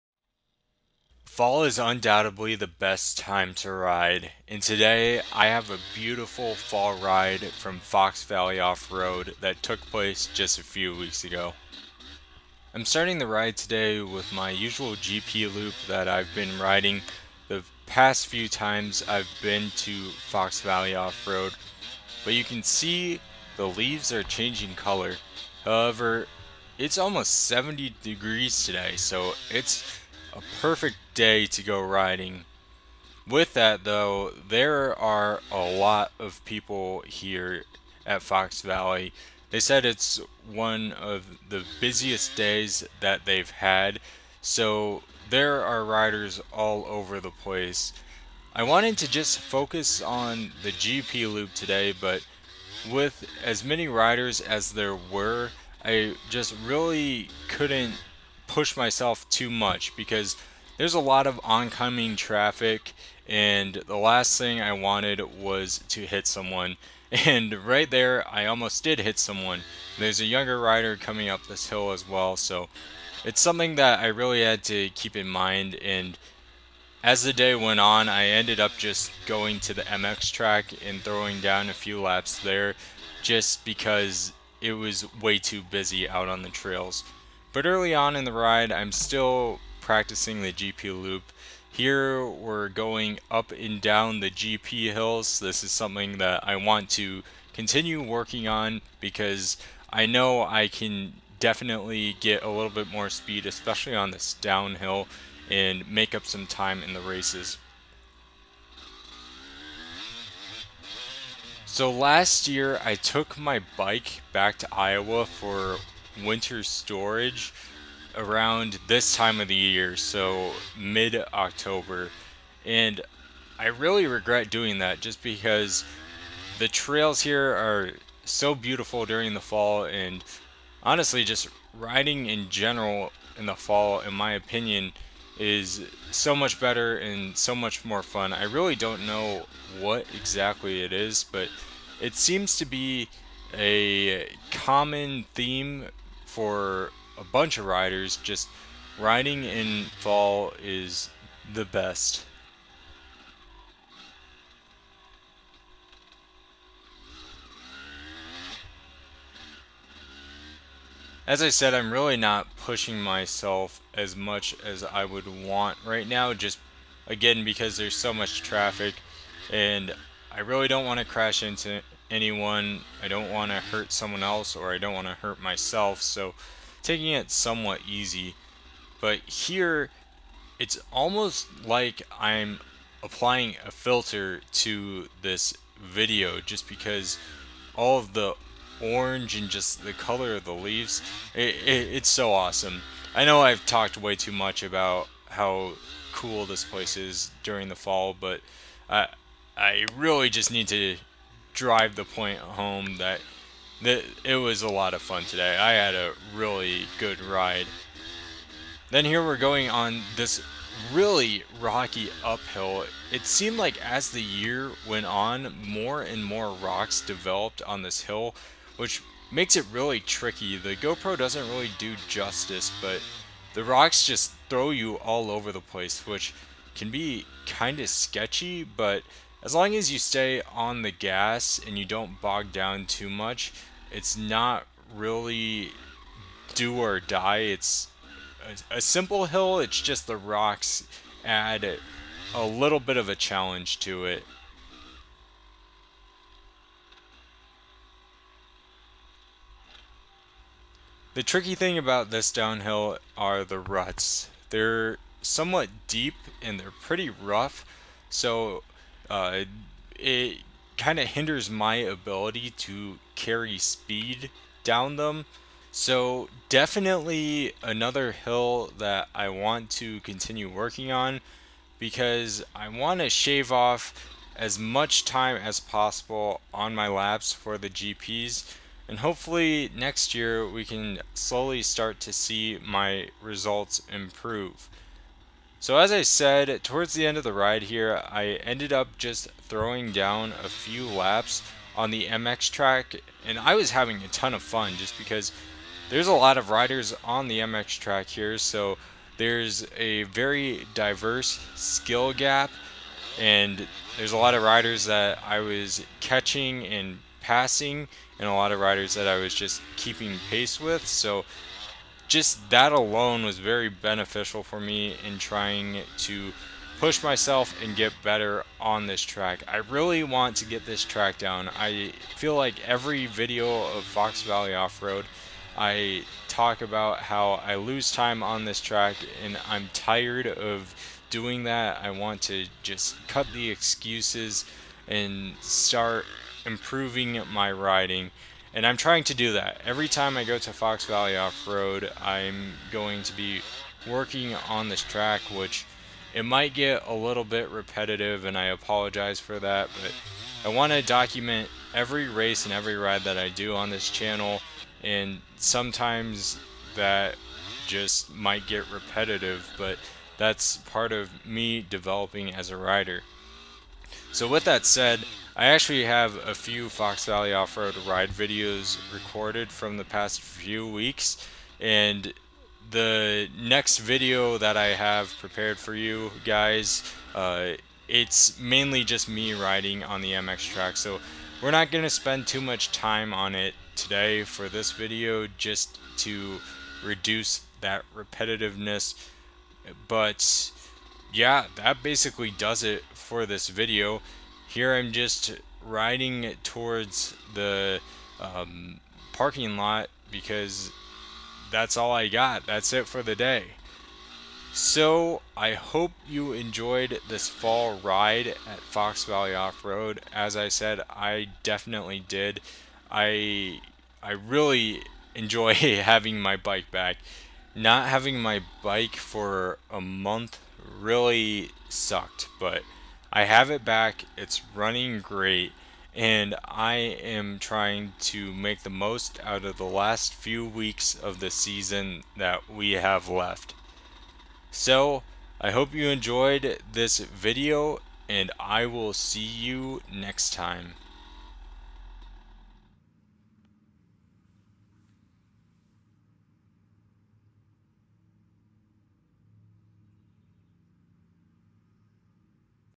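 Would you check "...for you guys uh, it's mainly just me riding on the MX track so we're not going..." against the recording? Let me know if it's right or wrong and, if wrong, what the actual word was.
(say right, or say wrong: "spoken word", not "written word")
right.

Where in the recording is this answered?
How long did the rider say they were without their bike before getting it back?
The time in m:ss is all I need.
6:59.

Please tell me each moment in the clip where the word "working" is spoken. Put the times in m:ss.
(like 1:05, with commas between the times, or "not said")
1:38, 4:30, 5:43.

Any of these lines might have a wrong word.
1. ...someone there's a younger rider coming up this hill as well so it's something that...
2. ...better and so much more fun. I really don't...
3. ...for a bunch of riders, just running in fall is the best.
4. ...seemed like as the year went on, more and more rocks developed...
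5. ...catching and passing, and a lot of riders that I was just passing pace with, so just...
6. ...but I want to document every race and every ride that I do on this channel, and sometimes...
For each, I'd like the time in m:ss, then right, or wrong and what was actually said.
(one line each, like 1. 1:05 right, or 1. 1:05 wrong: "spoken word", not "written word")
1. 1:09 right
2. 2:16 right
3. 2:26 wrong: "riding", not "running"
4. 3:33 right
5. 5:05 wrong: "keeping", not "passing"
6. 5:49 right.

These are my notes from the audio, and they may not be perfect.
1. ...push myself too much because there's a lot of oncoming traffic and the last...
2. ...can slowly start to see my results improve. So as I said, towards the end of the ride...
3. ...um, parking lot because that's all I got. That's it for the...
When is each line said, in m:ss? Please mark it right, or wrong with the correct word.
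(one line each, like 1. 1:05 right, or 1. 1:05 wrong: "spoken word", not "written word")
1. 0:58 right
2. 4:40 right
3. 6:38 right.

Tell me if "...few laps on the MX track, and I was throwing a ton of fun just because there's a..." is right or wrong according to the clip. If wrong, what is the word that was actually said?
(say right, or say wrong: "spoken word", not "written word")
wrong: "having", not "throwing".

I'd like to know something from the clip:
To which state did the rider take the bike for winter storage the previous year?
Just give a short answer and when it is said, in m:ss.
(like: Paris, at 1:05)
Iowa, at 1:54.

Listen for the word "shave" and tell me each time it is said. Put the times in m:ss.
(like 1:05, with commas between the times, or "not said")
4:33.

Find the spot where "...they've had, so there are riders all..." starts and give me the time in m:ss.
0:43.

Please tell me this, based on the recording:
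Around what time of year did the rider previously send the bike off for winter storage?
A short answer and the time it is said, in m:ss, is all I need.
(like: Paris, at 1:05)
mid October, at 2:00.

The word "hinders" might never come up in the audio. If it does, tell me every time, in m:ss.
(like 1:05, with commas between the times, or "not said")
4:21.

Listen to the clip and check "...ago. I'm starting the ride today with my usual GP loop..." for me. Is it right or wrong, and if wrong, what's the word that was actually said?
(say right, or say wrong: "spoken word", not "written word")
right.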